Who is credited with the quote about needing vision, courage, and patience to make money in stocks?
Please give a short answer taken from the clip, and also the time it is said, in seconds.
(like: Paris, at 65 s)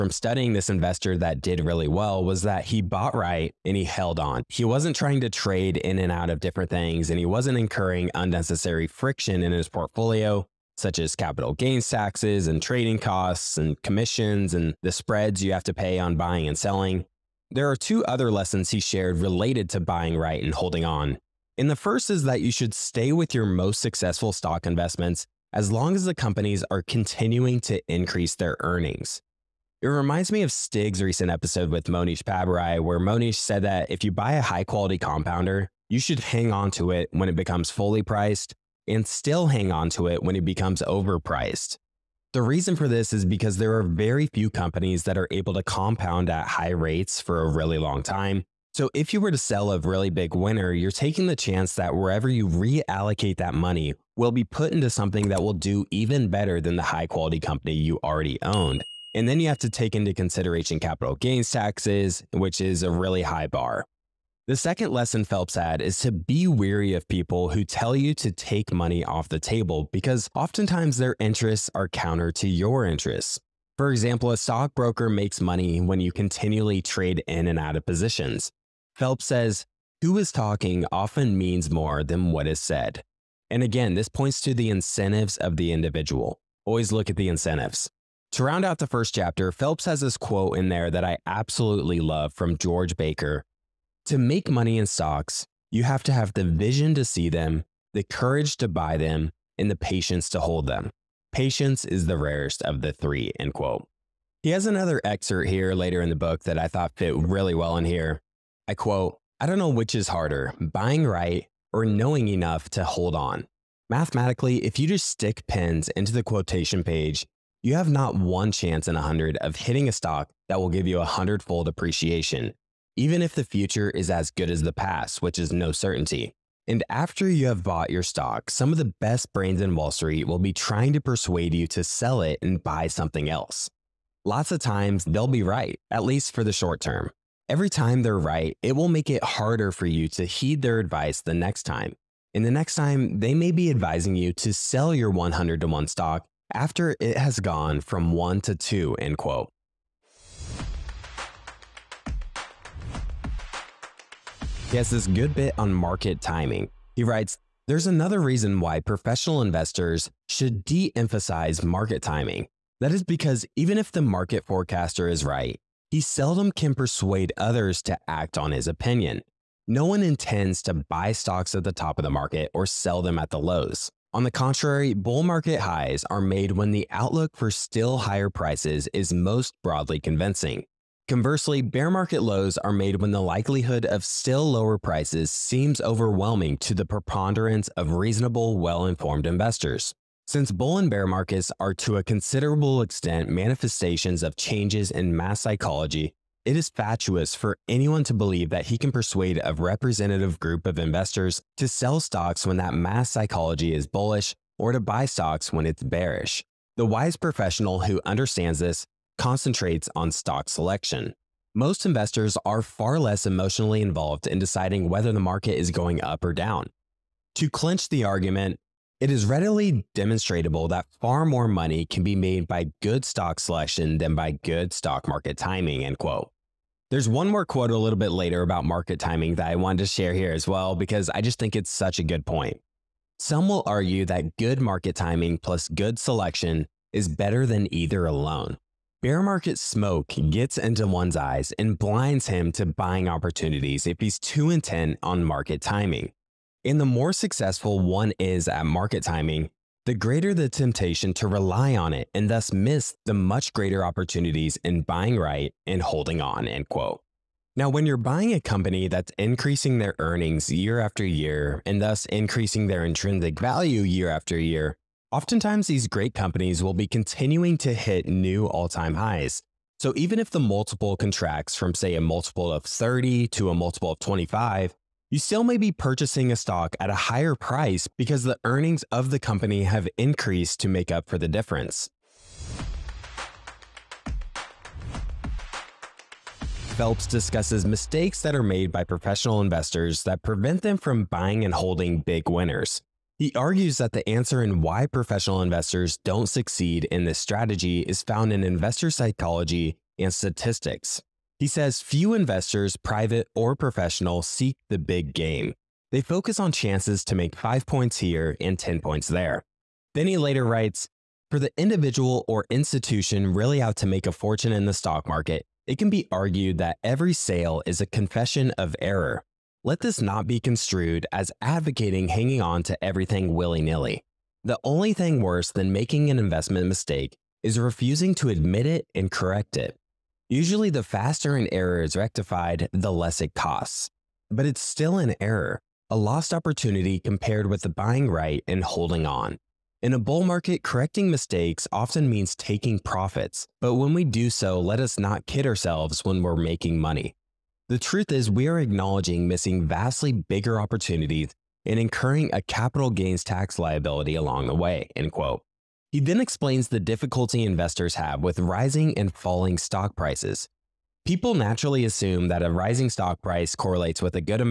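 George Baker, at 92 s.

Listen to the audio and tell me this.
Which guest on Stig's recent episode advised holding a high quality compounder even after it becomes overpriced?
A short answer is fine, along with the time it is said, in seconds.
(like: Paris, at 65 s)
Mohnish Pabrai, at 31 s.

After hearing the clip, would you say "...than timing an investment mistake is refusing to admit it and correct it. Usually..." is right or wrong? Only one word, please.
wrong.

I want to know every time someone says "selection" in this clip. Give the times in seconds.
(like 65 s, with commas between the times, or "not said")
210 s, 223 s, 235 s.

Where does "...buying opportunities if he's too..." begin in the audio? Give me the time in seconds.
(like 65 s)
242 s.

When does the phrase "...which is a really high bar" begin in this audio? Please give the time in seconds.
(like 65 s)
62 s.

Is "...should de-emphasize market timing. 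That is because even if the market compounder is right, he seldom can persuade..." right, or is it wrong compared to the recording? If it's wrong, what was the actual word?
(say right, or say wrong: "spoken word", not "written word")
wrong: "forecaster", not "compounder".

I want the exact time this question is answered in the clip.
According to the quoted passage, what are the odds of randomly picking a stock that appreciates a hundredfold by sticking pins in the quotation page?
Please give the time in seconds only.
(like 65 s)
117 s.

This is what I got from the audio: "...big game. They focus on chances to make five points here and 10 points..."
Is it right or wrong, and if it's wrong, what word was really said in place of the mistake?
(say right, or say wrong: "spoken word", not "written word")
right.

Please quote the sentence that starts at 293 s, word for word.
He argues that the answer in why professional investors don't succeed in this strategy is found in investor psychology and statistics.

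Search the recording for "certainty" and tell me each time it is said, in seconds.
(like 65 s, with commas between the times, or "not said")
125 s.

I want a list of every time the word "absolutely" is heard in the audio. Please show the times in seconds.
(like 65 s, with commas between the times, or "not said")
91 s.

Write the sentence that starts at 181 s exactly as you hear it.
Conversely, bear market lows are made when the likelihood of still lower prices seems overwhelming to the preponderance of reasonable, well-informed investors.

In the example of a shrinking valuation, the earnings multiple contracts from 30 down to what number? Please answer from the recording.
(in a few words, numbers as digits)
25.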